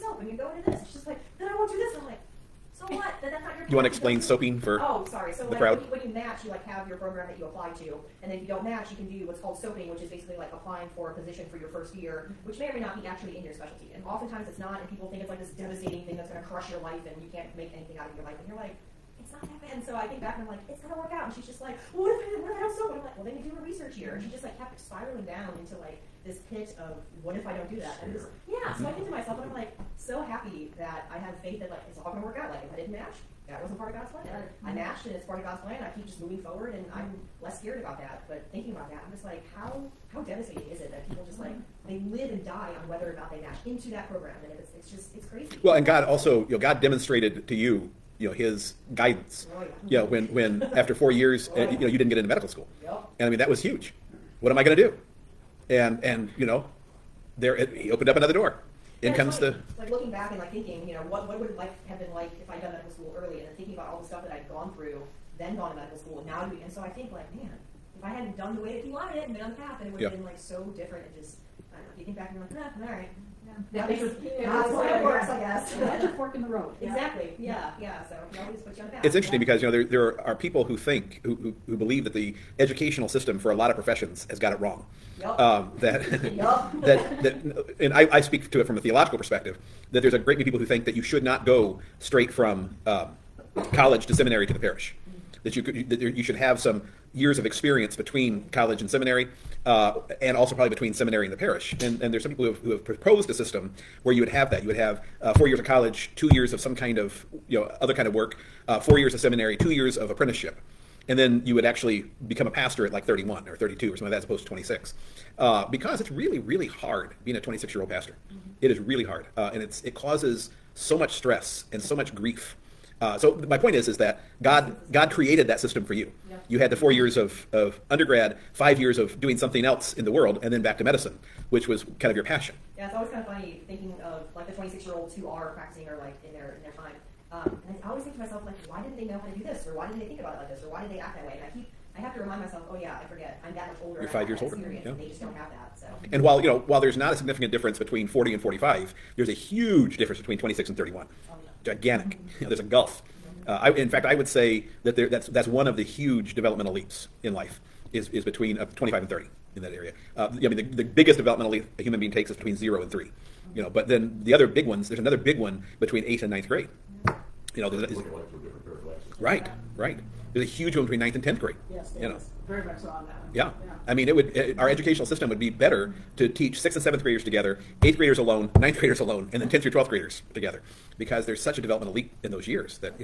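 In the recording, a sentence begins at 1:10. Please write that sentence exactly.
been like so different and just.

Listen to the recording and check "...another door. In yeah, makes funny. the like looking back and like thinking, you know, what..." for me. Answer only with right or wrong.
wrong.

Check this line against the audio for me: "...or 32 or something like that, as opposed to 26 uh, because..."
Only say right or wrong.
right.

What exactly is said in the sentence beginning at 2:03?
Uh, so my point is, is that God God created that system for you.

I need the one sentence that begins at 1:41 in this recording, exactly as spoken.
And and there's some people who have who have proposed a system where you would have that.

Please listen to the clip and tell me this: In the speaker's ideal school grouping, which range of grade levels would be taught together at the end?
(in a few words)
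10th through 12th.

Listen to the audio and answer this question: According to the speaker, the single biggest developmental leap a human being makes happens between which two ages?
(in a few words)
0 and 3.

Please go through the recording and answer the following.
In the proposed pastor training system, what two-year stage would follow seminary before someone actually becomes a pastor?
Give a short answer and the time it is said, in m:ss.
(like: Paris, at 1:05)
apprenticeship, at 1:50.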